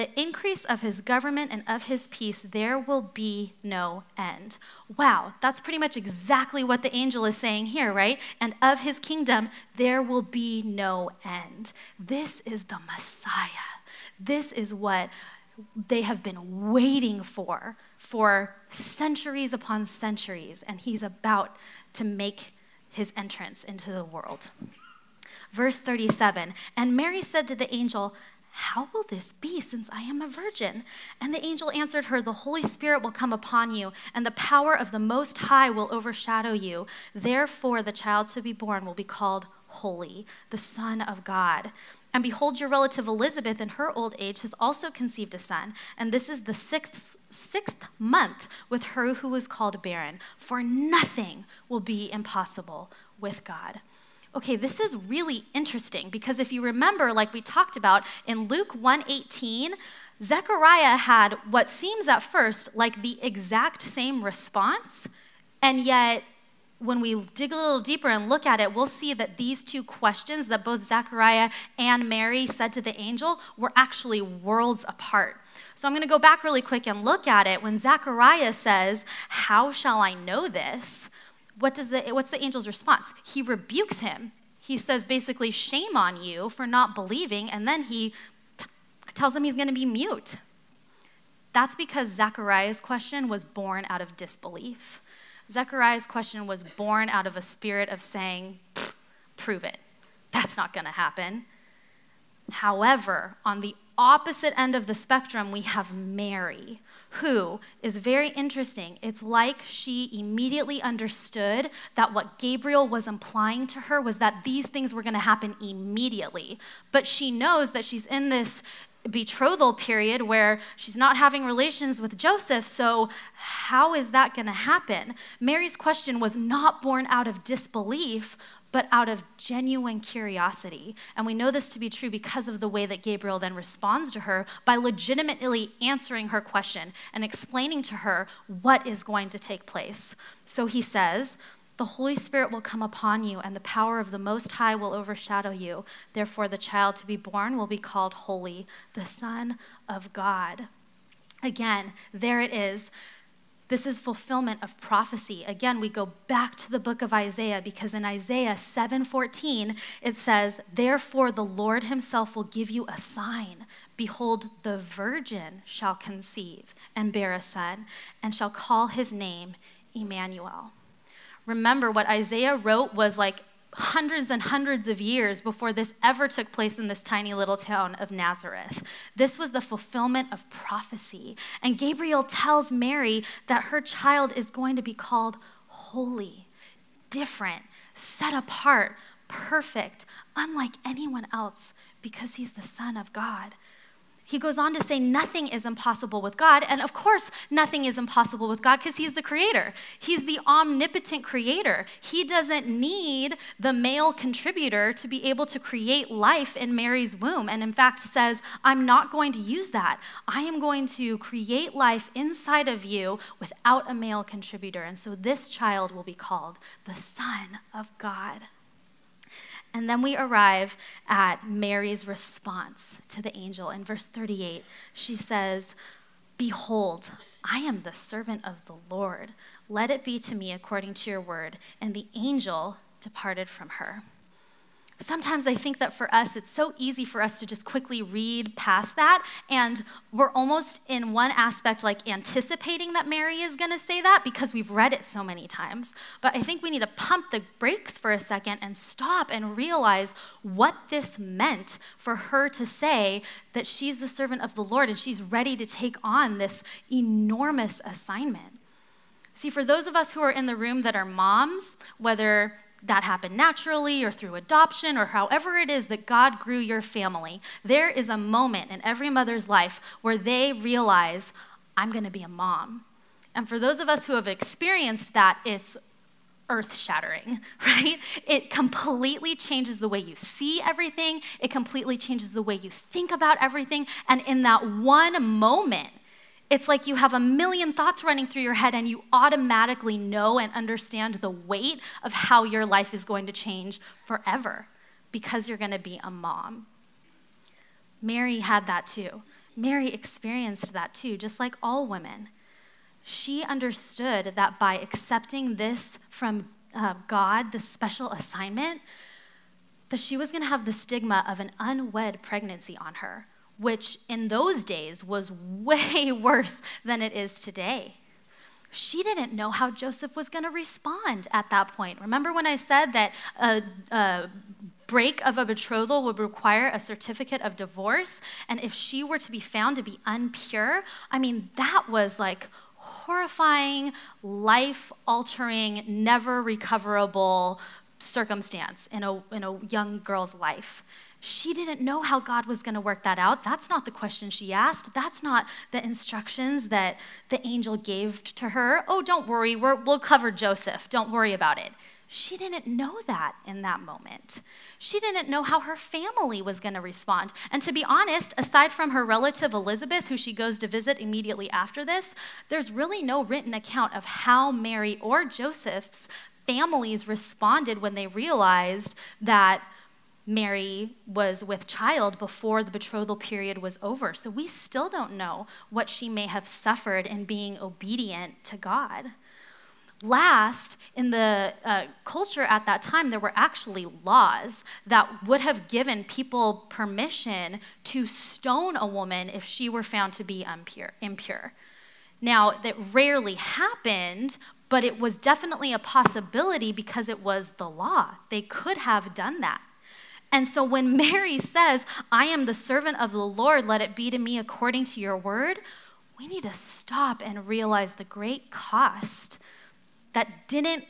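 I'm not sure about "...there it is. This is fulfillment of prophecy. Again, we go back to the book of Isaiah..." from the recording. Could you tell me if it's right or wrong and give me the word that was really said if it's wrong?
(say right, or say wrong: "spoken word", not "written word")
right.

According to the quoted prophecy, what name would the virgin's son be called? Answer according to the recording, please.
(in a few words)
Emmanuel.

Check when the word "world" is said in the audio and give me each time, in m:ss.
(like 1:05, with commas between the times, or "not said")
0:24, 1:14.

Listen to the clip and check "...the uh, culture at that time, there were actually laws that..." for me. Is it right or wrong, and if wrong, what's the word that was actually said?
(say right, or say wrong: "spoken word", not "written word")
right.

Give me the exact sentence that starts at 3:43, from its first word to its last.
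In verse 38, she says, Behold, I am the servant of the Lord.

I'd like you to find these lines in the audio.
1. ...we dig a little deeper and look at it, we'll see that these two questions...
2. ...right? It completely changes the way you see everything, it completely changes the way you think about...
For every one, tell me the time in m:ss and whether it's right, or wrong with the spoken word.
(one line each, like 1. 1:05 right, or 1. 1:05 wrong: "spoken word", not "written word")
1. 1:07 right
2. 4:37 right.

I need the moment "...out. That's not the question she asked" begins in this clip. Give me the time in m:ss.
5:43.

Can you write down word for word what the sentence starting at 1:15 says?
So I'm going to go back really quick and look at it.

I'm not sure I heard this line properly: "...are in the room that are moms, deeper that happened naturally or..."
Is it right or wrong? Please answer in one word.
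wrong.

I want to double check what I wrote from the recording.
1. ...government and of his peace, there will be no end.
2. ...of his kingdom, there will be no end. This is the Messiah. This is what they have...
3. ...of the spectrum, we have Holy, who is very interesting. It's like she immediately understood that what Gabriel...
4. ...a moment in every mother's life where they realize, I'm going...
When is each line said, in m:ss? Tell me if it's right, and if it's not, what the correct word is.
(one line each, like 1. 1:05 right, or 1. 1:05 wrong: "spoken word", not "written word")
1. 0:00 right
2. 0:08 right
3. 1:44 wrong: "Mary", not "Holy"
4. 4:28 right.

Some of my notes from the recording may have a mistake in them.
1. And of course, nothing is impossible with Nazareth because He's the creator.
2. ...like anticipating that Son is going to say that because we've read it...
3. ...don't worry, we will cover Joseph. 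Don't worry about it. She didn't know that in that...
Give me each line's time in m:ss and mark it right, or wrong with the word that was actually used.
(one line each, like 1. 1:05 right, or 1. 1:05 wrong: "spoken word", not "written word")
1. 3:16 wrong: "God", not "Nazareth"
2. 4:01 wrong: "Mary", not "Son"
3. 5:49 right.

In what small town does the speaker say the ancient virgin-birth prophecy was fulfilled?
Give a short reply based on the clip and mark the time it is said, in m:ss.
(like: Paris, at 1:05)
Nazareth, at 2:58.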